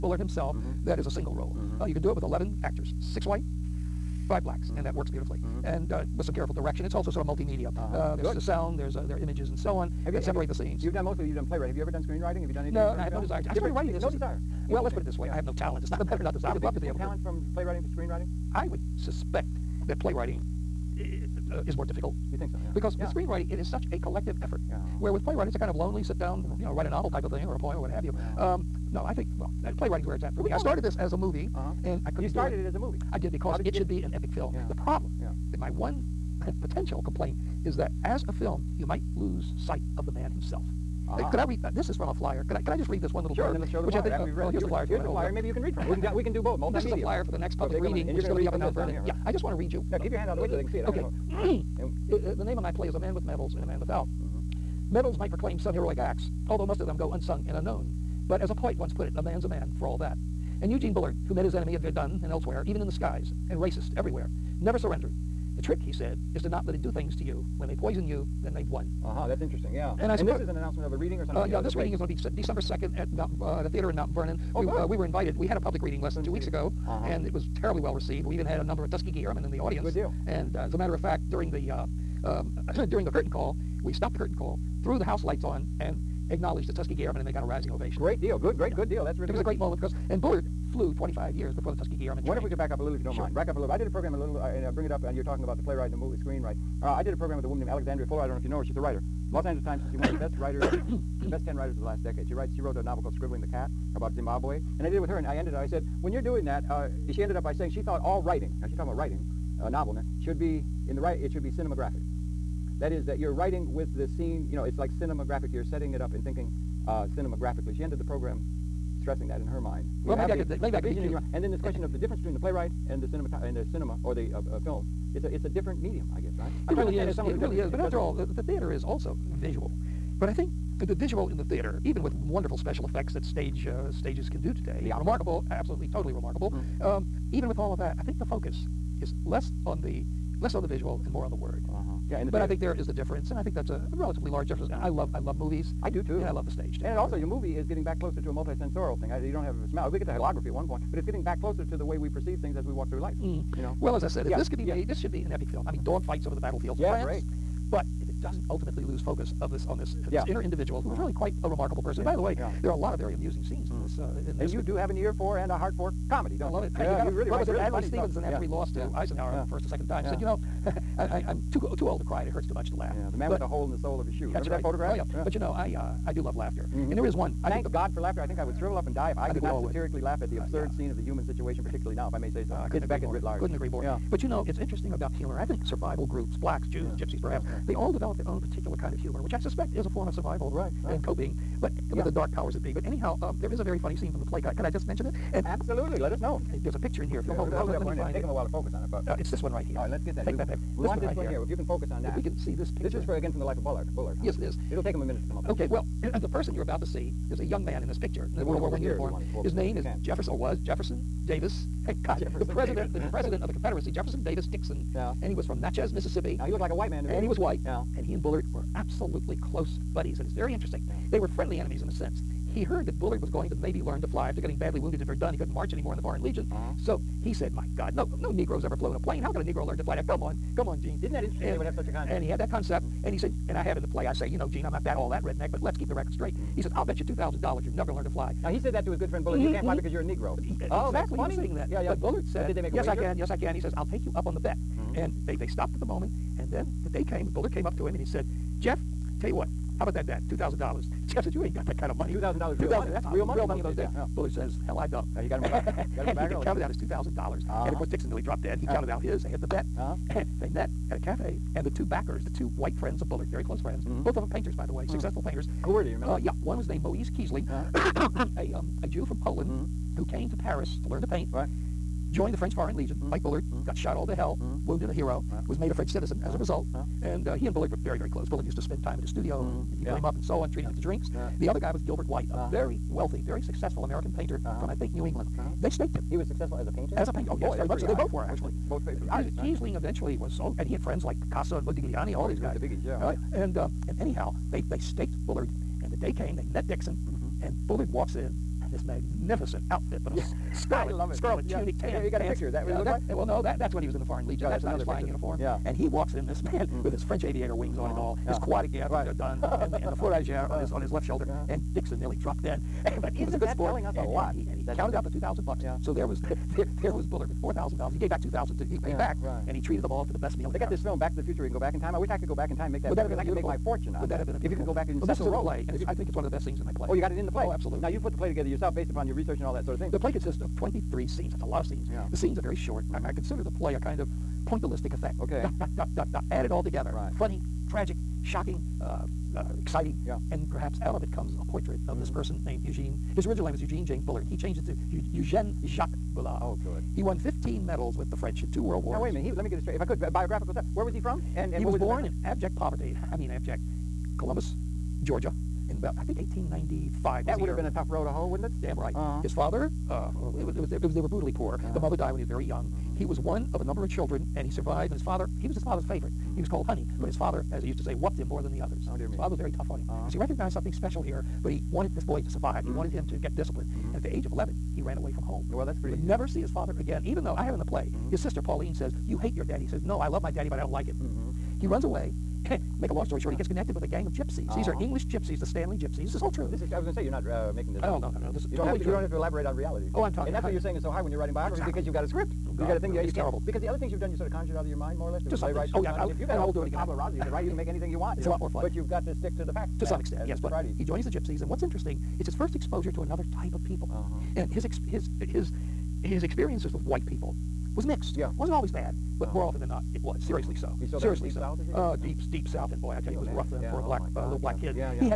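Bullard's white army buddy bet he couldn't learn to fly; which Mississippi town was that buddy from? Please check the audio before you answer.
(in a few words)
Natchez.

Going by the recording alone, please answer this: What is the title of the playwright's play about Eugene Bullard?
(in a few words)
A Man with Medals and A Man Without.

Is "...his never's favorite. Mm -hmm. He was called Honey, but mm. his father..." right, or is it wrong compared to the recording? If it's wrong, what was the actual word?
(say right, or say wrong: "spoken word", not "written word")
wrong: "father", not "never".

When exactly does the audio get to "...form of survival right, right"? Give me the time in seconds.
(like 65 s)
189 s.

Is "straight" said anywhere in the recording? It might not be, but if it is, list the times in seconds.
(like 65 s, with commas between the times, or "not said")
236 s, 349 s.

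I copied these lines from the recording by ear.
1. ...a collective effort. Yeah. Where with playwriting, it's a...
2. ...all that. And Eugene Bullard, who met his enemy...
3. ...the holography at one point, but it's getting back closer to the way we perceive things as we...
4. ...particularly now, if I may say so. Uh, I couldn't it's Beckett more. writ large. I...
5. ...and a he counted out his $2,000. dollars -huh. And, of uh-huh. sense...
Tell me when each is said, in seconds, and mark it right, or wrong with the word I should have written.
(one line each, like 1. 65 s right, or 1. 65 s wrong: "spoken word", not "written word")
1. 23 s right
2. 59 s right
3. 150 s right
4. 181 s right
5. 256 s wrong: "course", not "sense".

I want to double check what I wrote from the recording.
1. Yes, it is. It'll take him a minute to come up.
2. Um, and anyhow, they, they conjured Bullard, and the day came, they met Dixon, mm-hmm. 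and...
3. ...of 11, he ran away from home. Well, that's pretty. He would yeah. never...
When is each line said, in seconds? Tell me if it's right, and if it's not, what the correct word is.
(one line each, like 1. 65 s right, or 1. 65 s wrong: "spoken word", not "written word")
1. 204 s right
2. 293 s wrong: "staked", not "conjured"
3. 374 s right.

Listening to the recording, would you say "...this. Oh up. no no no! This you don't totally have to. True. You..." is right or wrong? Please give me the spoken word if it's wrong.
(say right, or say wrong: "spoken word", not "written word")
right.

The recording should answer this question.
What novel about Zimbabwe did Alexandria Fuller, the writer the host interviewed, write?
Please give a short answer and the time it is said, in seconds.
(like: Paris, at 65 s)
Scribbling the Cat, at 103 s.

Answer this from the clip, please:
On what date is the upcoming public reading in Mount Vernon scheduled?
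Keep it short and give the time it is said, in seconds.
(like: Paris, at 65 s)
December 2nd, at 72 s.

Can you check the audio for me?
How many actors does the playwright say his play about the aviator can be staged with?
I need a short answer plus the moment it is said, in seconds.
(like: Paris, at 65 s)
11, at 2 s.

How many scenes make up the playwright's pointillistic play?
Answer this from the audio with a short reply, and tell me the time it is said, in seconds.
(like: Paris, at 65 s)
23, at 330 s.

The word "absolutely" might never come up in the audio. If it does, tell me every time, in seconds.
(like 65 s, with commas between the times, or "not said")
135 s, 195 s, 218 s, 327 s.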